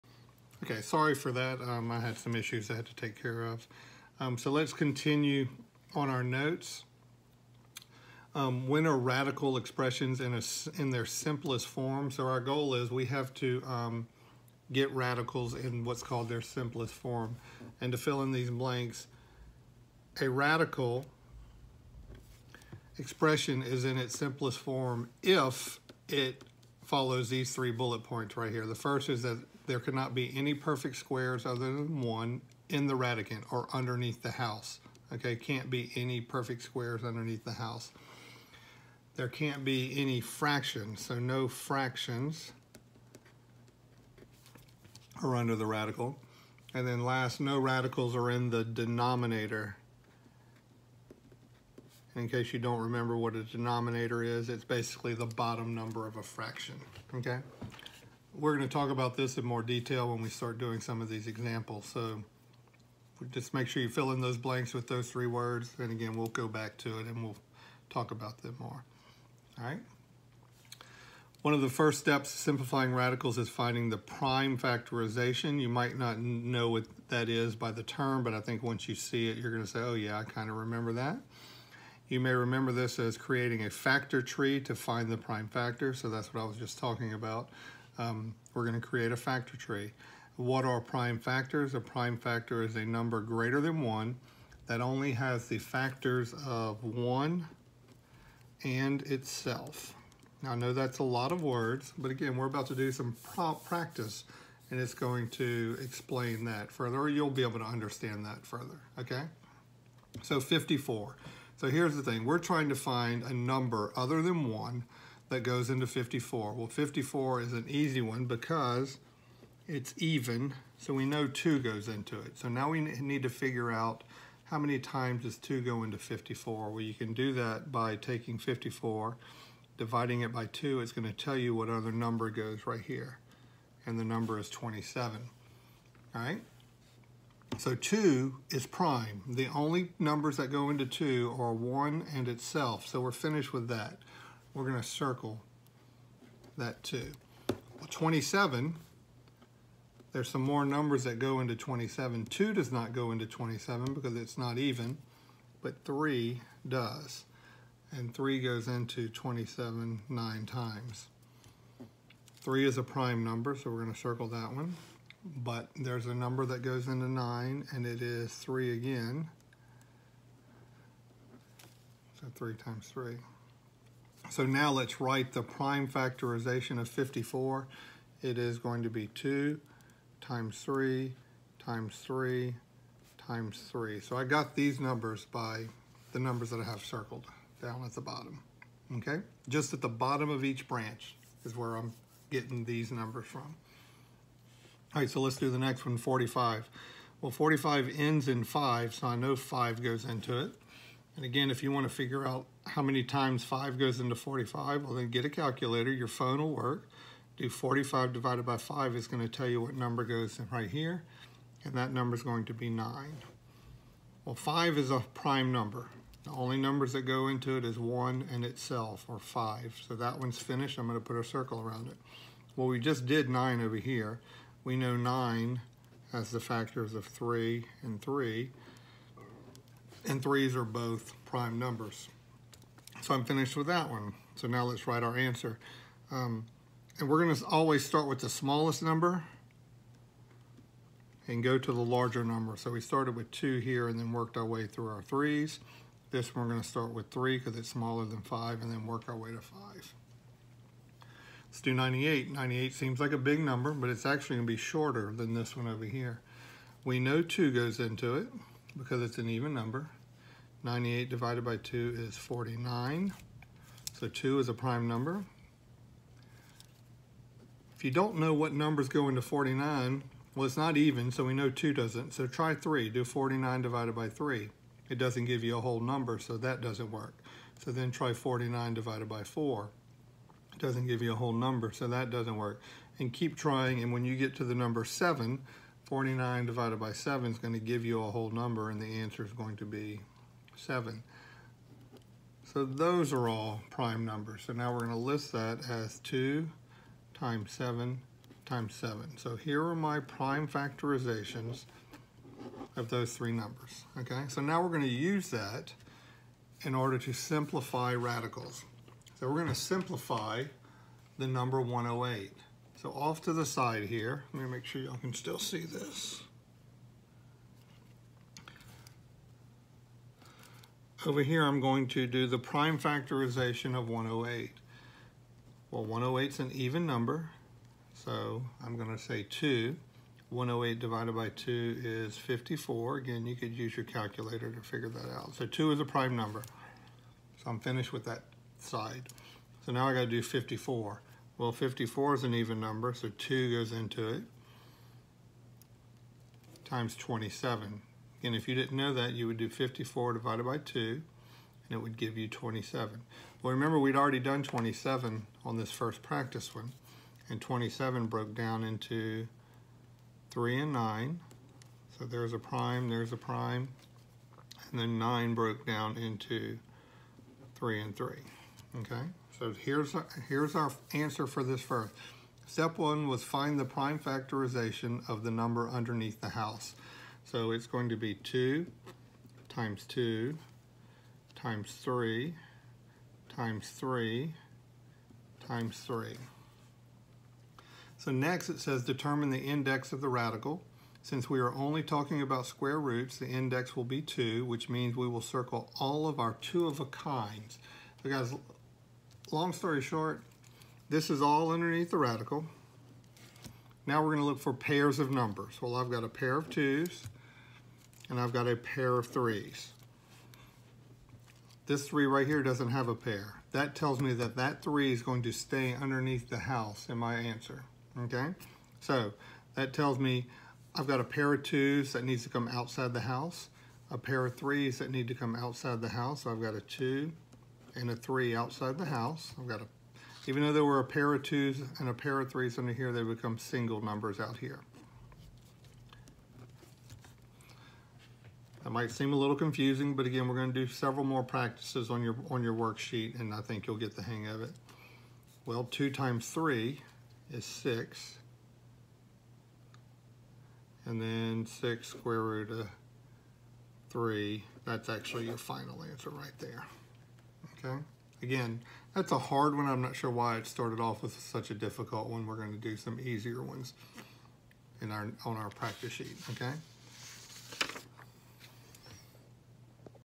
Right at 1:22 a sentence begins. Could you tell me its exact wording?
You may remember this as creating a factor tree to find the prime factor, so that's what I was just talking about.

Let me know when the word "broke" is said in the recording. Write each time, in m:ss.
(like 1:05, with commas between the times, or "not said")
5:58, 6:05.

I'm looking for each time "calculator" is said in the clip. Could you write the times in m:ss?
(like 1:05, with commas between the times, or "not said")
3:25, 5:33.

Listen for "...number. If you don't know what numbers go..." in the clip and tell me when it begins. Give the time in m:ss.
4:24.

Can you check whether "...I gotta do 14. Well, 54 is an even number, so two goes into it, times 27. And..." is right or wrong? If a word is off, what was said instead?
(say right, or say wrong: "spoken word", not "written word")
wrong: "54", not "14".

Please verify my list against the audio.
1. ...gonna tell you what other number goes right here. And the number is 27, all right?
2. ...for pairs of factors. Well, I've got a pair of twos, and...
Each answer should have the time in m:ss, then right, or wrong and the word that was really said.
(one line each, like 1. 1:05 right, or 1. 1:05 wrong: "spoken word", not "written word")
1. 2:10 right
2. 6:44 wrong: "numbers", not "factors".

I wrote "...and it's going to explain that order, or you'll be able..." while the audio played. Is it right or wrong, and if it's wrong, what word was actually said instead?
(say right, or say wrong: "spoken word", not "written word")
wrong: "further", not "order".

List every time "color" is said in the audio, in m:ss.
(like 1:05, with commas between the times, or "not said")
not said.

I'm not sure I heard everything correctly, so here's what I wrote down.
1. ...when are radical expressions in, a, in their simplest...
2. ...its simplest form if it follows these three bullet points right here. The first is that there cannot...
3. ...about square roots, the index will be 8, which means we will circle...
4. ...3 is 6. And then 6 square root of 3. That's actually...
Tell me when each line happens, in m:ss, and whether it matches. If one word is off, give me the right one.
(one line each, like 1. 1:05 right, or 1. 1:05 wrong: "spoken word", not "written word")
1. 0:08 right
2. 0:23 right
3. 6:32 wrong: "2", not "8"
4. 7:26 right.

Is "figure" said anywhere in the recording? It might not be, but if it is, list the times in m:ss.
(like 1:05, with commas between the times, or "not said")
2:03, 3:21, 5:34.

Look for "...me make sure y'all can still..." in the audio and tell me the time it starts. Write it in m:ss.
5:14.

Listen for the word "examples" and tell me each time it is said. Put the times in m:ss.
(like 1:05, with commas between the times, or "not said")
1:01.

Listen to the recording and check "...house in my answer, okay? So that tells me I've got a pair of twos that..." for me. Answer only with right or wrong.
right.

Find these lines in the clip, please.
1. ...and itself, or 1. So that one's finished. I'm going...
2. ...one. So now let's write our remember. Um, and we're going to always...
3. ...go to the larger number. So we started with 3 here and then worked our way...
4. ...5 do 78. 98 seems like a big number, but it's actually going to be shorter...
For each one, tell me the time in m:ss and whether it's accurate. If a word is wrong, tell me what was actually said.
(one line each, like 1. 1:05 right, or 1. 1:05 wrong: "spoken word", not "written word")
1. 3:38 wrong: "5", not "1"
2. 3:53 wrong: "answer", not "remember"
3. 4:01 wrong: "2", not "3"
4. 4:09 wrong: "98", not "78".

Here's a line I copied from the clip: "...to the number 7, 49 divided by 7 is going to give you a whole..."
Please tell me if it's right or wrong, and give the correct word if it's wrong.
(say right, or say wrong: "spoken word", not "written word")
right.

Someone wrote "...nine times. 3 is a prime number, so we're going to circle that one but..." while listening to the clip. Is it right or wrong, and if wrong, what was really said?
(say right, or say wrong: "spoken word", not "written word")
right.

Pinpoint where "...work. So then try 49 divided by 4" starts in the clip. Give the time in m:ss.
4:36.